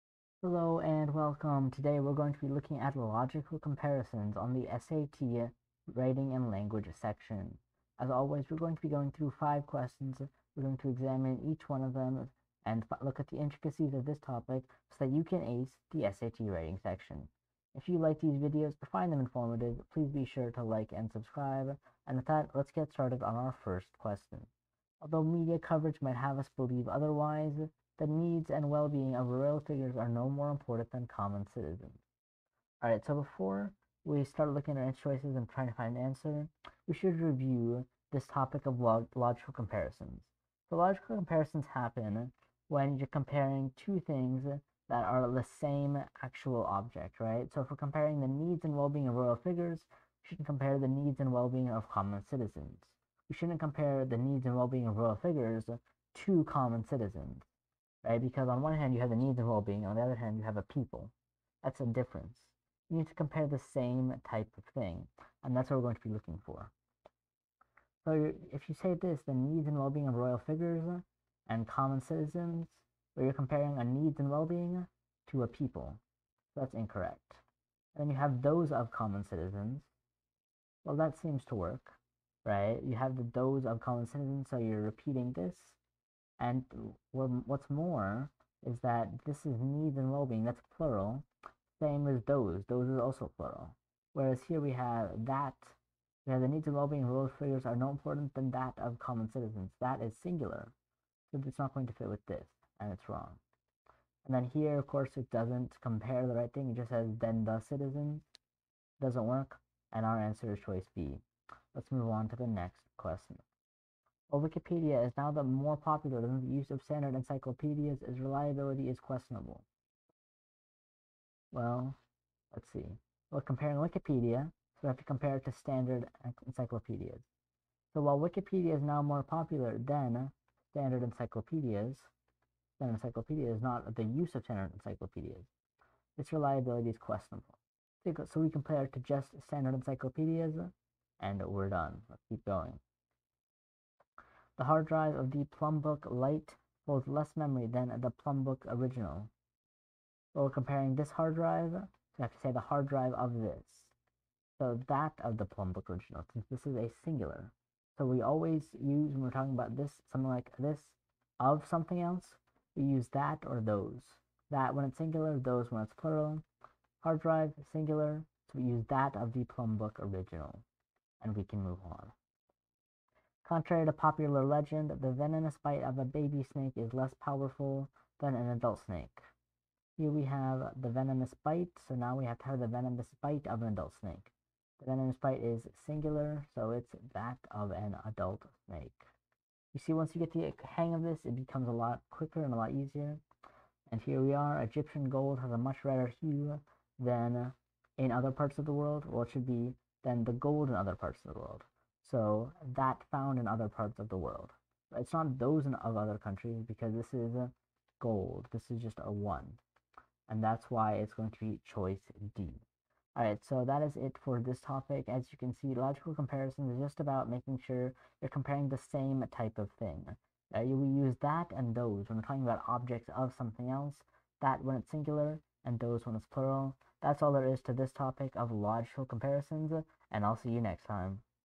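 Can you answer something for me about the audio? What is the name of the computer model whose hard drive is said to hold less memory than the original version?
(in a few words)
Plumbook Lite.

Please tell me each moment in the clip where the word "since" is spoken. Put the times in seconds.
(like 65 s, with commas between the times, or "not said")
156 s.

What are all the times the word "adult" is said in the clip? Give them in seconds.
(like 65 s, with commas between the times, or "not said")
178 s, 183 s, 188 s.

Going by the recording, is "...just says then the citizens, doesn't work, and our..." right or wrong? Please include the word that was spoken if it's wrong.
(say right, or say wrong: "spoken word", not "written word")
right.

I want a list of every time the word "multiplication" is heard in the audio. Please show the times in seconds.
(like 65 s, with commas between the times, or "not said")
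not said.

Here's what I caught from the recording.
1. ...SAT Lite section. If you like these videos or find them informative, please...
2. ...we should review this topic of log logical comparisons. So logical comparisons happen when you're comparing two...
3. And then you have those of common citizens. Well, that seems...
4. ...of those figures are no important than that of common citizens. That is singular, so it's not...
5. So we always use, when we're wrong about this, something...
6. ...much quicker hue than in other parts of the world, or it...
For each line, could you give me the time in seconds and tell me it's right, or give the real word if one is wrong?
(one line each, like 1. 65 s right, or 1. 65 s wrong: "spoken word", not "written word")
1. 16 s wrong: "Writing", not "Lite"
2. 36 s right
3. 77 s right
4. 97 s right
5. 157 s wrong: "talking", not "wrong"
6. 195 s wrong: "redder", not "quicker".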